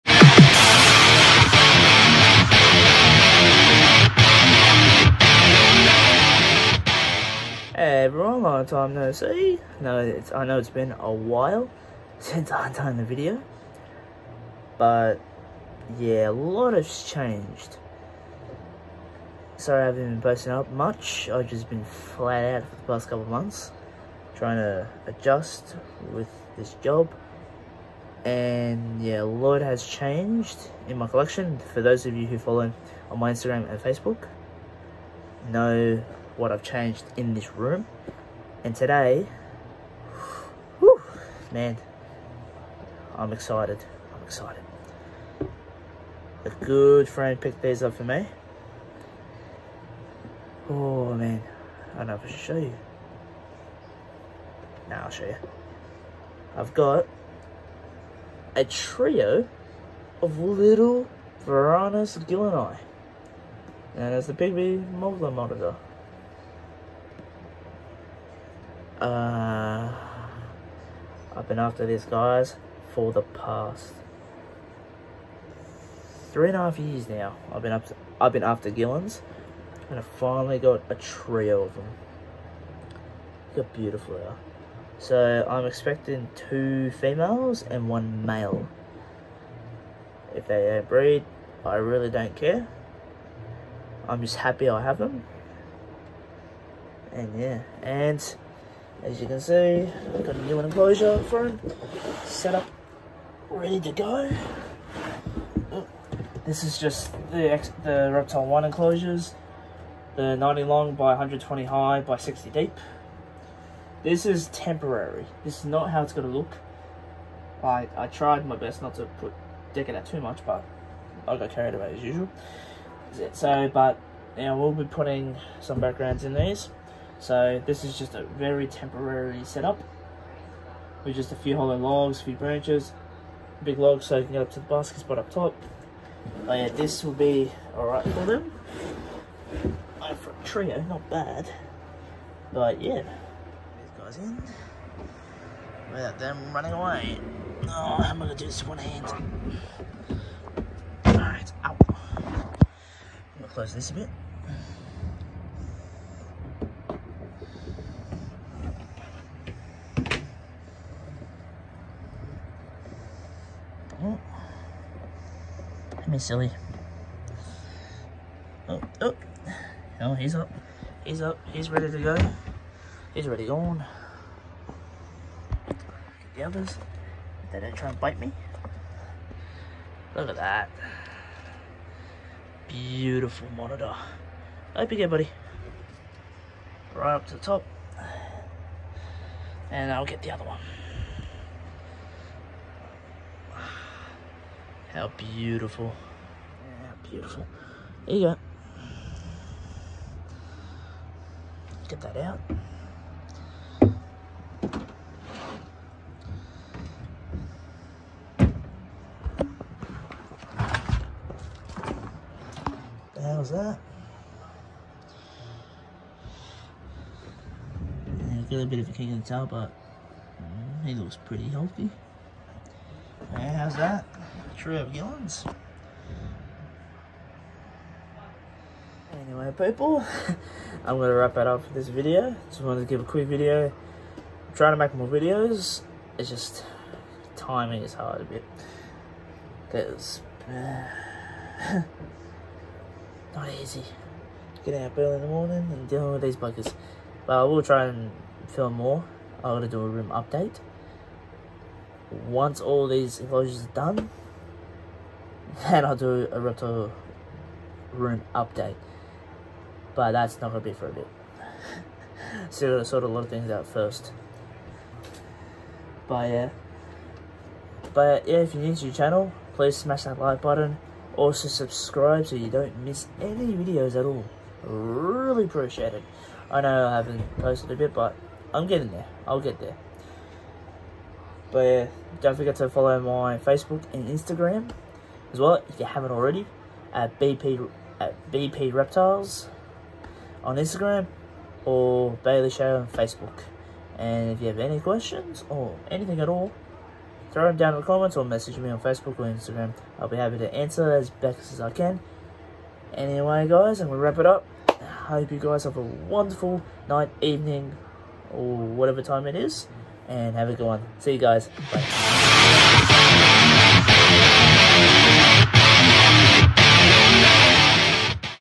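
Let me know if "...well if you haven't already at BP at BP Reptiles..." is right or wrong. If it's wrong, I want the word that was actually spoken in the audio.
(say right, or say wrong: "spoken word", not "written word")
right.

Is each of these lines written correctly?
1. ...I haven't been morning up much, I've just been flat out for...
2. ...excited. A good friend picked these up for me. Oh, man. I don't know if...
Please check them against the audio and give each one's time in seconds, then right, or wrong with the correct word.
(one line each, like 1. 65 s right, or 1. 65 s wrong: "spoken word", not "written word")
1. 19 s wrong: "posting", not "morning"
2. 44 s right.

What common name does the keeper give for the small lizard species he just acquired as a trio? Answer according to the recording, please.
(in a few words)
pygmy mulga monitor.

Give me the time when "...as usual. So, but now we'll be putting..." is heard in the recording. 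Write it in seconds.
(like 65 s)
121 s.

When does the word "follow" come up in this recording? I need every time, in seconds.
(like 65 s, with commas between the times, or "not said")
32 s, 282 s.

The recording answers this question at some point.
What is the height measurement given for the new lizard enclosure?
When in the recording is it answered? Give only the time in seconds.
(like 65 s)
111 s.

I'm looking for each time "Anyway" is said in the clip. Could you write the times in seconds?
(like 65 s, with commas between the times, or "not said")
229 s, 302 s.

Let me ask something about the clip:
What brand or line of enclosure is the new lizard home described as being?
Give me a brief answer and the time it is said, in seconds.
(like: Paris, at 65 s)
Reptile 1, at 108 s.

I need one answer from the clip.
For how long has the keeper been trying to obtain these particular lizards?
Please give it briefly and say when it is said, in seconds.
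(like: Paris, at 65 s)
3.5 years, at 76 s.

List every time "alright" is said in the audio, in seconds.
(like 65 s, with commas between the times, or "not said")
137 s, 151 s.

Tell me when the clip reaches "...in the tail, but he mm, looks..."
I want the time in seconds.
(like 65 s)
219 s.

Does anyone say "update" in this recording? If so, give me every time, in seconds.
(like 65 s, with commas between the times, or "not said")
250 s, 258 s.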